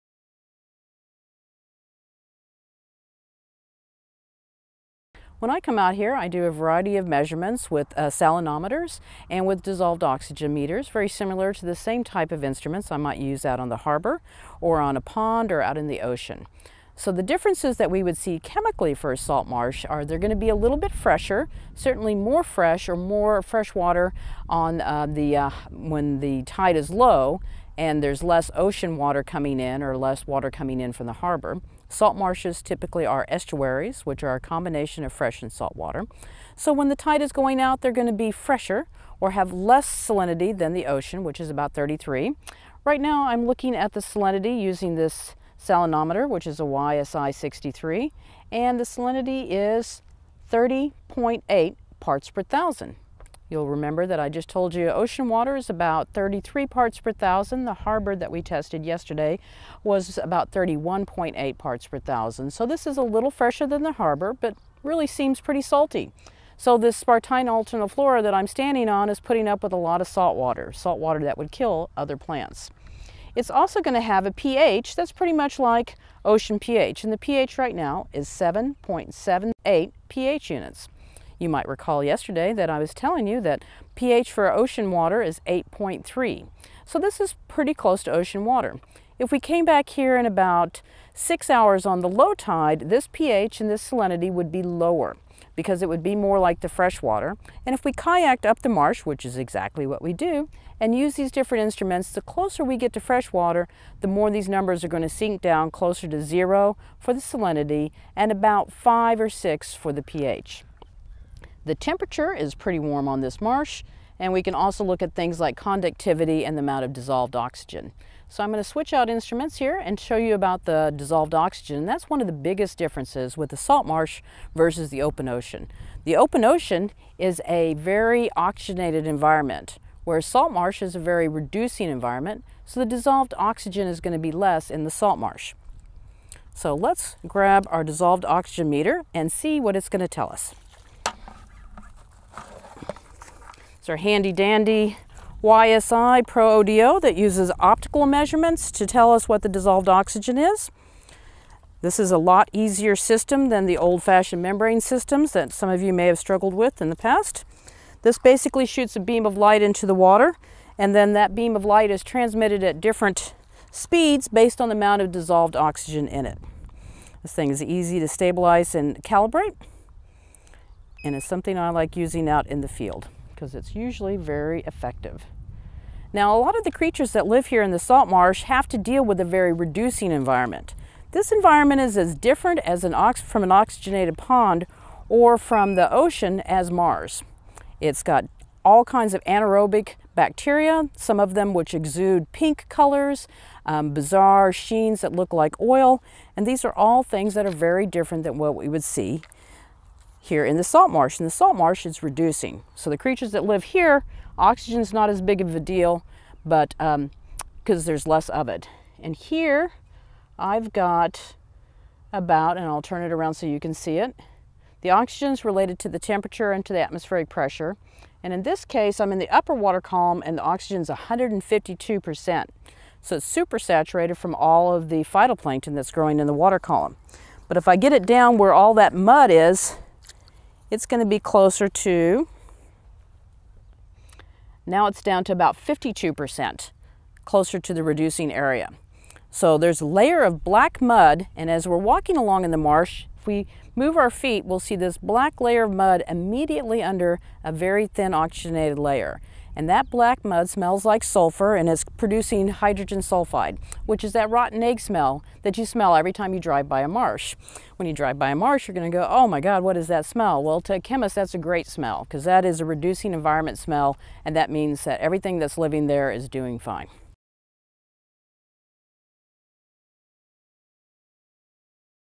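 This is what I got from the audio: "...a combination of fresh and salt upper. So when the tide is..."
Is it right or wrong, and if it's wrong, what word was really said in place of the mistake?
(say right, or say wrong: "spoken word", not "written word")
wrong: "water", not "upper".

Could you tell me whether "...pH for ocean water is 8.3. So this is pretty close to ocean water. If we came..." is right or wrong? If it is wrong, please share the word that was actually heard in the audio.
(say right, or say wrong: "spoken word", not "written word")
right.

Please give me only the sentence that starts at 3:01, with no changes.
This environment is as different as an from an oxygenated pond or from the ocean as Mars.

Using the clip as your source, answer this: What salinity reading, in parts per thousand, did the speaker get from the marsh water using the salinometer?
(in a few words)
30.8.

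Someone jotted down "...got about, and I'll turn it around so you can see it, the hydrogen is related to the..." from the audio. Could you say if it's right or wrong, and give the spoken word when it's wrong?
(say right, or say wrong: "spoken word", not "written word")
wrong: "oxygen", not "hydrogen".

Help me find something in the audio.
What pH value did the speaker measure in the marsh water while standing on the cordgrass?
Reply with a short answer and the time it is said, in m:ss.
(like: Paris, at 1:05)
7.78, at 1:18.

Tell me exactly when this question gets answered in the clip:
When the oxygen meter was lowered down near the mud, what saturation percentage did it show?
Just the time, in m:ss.
3:55.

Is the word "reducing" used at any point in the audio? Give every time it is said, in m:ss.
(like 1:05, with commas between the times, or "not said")
2:11, 2:59, 3:22, 3:57, 4:22.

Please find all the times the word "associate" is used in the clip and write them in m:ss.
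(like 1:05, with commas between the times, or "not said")
not said.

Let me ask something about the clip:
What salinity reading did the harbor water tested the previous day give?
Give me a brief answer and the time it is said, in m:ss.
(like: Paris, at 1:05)
31.8 parts per thousand, at 1:00.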